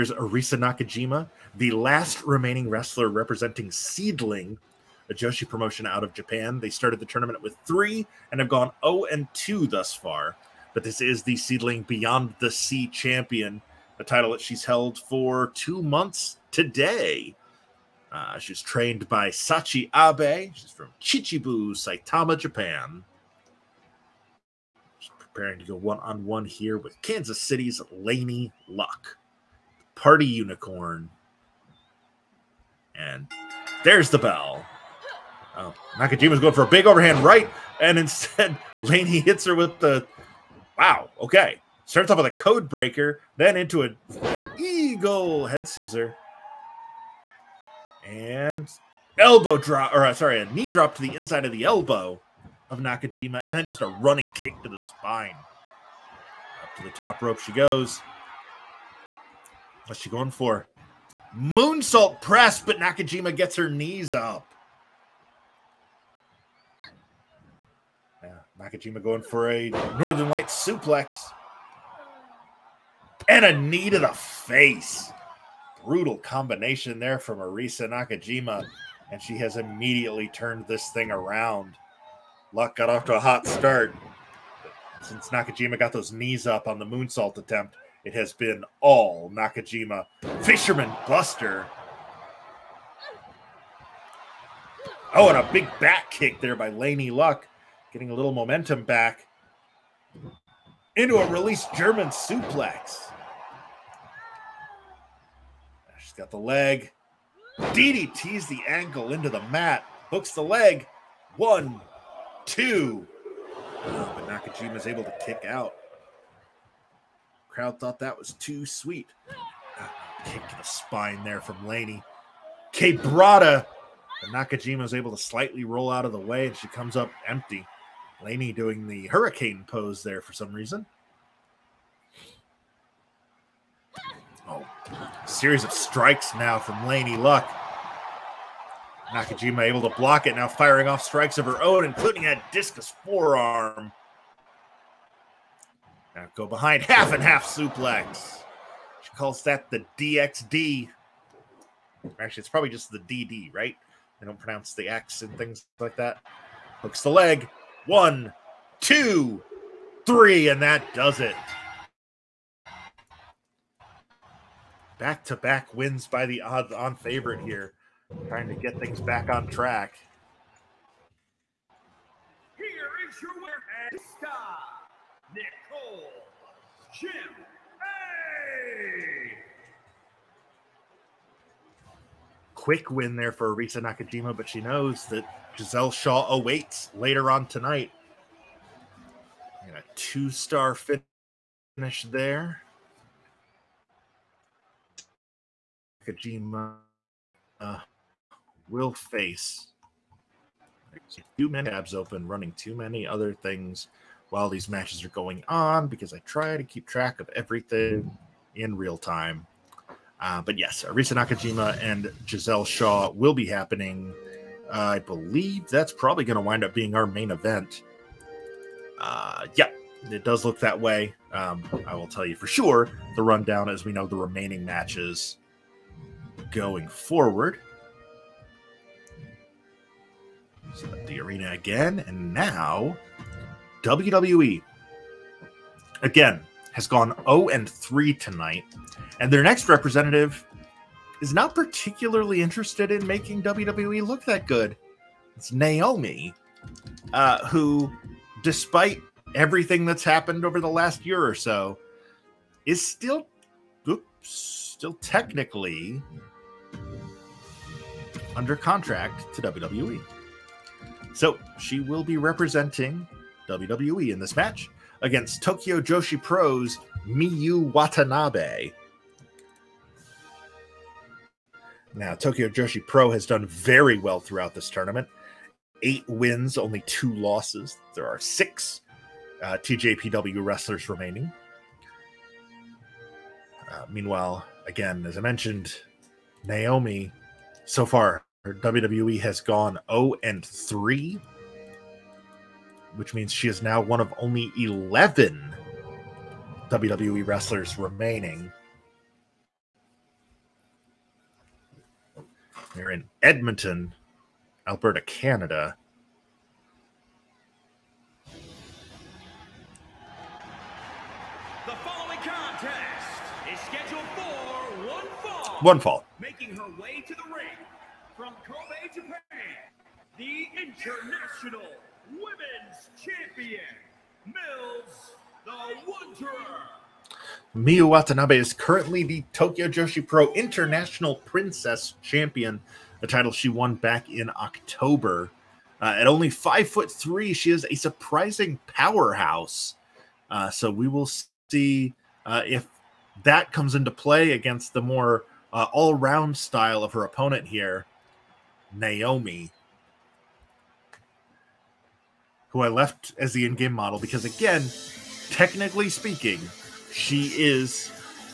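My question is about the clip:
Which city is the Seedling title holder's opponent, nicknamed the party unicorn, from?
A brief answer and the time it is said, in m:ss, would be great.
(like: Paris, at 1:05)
Kansas City, at 0:27.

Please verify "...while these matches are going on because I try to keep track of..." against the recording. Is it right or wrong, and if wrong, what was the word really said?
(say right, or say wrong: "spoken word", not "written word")
right.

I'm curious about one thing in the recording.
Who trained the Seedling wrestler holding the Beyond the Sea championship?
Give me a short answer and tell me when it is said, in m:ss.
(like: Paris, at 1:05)
Sachi Abe, at 0:19.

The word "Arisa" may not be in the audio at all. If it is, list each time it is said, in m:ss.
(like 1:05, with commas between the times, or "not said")
0:00, 1:17, 3:03, 3:30.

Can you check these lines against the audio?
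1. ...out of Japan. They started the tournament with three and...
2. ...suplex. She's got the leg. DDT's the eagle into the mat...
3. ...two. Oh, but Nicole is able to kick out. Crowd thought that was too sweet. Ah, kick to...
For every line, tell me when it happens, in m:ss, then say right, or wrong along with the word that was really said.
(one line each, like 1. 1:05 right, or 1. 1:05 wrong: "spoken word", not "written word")
1. 0:05 right
2. 1:42 wrong: "ankle", not "eagle"
3. 1:52 wrong: "Nakajima", not "Nicole".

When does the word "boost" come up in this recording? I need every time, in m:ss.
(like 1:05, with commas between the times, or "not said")
not said.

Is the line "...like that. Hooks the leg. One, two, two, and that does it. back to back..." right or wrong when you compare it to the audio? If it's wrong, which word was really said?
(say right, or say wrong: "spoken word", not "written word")
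wrong: "three", not "two".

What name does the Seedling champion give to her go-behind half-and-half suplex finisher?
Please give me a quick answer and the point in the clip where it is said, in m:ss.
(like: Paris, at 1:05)
DXD, at 2:29.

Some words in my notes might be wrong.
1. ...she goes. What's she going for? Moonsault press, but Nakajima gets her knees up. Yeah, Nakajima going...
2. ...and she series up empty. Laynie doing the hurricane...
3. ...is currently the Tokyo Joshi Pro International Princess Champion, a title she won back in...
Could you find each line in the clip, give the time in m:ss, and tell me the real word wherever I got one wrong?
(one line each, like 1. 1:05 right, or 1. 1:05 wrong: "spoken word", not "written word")
1. 0:57 right
2. 2:06 wrong: "comes", not "series"
3. 5:28 right.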